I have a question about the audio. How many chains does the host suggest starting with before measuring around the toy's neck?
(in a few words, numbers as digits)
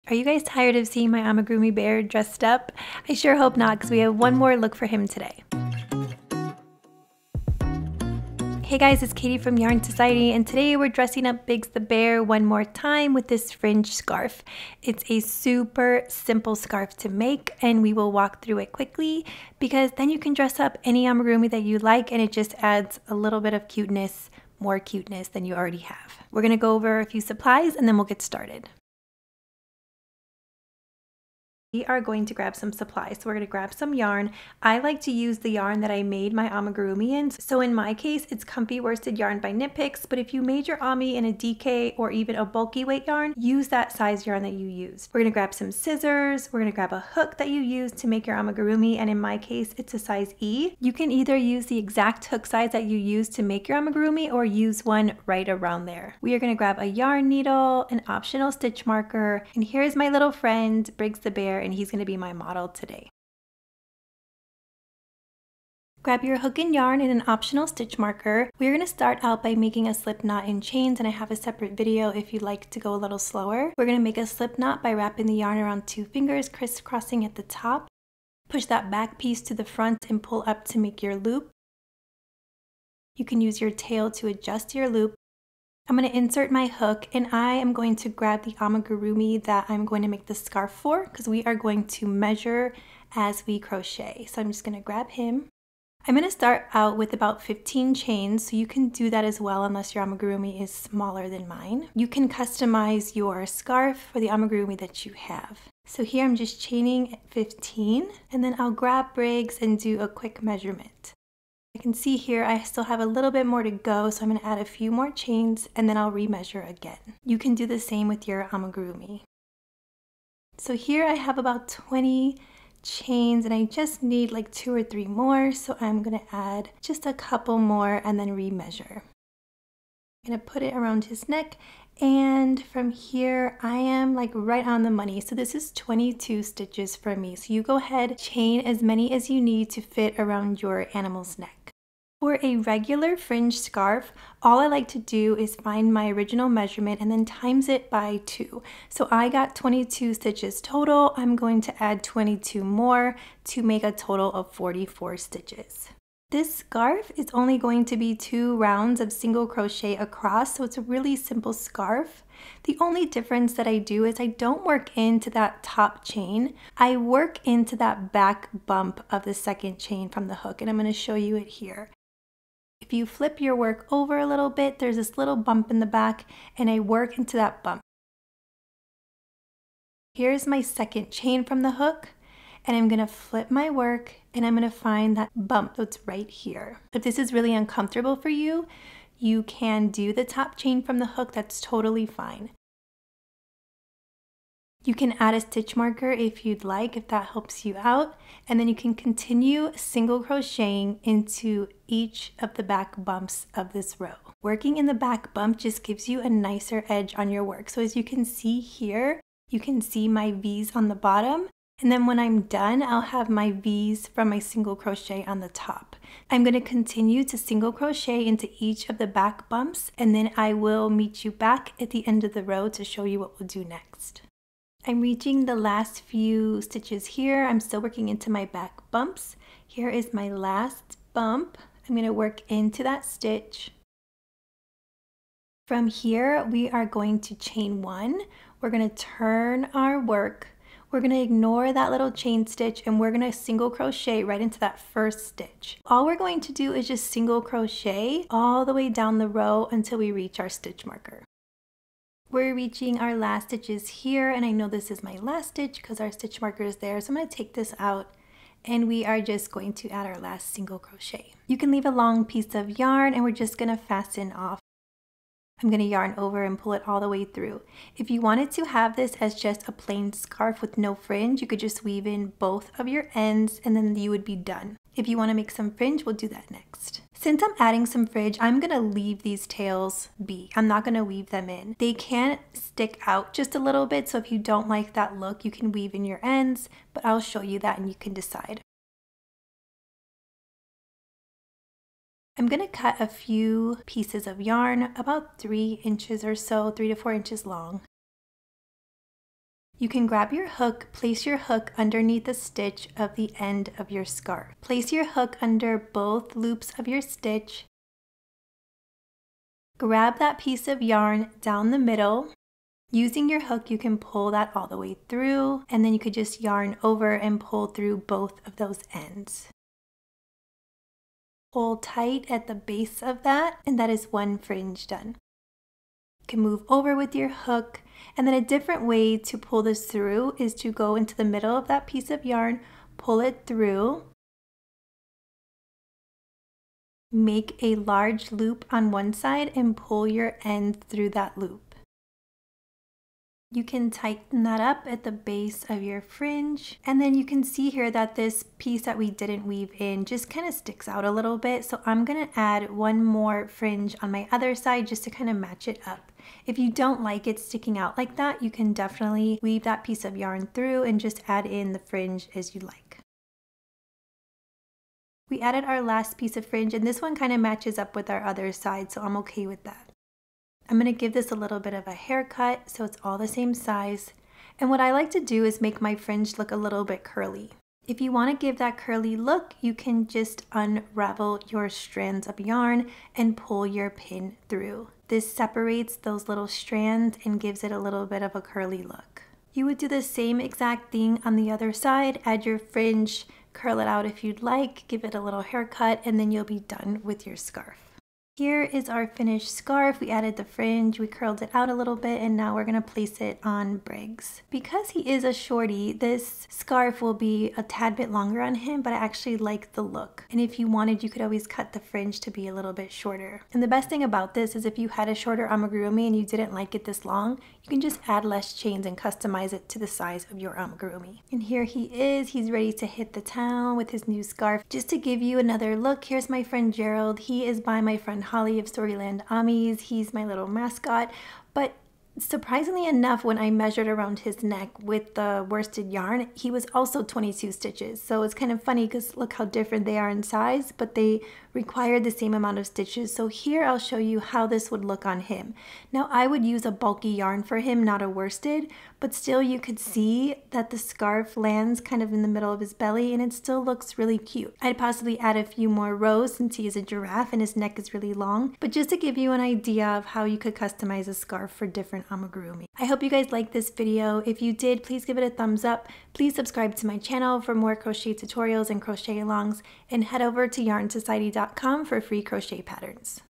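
15.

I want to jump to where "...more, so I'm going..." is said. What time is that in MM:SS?
02:05.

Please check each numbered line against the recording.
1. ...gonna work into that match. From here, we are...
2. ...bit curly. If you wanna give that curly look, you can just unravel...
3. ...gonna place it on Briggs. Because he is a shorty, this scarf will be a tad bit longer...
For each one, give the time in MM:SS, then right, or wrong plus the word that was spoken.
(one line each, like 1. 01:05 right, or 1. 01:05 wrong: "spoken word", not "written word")
1. 03:51 wrong: "stitch", not "match"
2. 06:16 right
3. 06:42 right.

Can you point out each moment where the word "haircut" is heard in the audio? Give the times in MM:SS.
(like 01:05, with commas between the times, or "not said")
06:11, 06:35.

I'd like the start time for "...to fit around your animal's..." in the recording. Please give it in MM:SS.
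02:19.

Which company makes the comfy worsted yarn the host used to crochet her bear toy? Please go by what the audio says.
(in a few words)
Knit Picks.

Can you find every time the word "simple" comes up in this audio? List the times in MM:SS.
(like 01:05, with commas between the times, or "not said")
00:16, 02:41.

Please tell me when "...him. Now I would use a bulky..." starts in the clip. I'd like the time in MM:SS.
07:25.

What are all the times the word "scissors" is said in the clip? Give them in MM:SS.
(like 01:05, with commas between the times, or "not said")
00:45.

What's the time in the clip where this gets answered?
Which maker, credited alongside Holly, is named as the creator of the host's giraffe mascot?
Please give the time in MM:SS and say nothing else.
07:08.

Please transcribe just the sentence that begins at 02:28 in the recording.
So I got 22 stitches total.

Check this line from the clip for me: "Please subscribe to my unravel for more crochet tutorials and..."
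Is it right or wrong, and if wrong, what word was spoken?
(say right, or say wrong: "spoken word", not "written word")
wrong: "channel", not "unravel".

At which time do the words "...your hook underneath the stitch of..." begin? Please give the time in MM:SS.
05:01.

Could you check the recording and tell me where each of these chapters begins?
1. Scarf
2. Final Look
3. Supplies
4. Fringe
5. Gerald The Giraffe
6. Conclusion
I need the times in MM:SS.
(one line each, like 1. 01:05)
1. 01:04
2. 06:38
3. 00:29
4. 04:49
5. 07:04
6. 07:43.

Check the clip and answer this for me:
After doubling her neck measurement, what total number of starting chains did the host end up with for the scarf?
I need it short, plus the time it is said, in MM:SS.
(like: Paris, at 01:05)
44, at 02:34.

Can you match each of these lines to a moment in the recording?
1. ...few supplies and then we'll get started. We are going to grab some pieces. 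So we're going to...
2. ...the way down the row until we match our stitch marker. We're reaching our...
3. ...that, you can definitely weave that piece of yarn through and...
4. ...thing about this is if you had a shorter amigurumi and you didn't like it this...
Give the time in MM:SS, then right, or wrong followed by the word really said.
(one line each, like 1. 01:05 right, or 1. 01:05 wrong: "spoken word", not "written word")
1. 00:27 wrong: "supplies", not "pieces"
2. 04:08 wrong: "reach", not "match"
3. 05:58 right
4. 06:53 right.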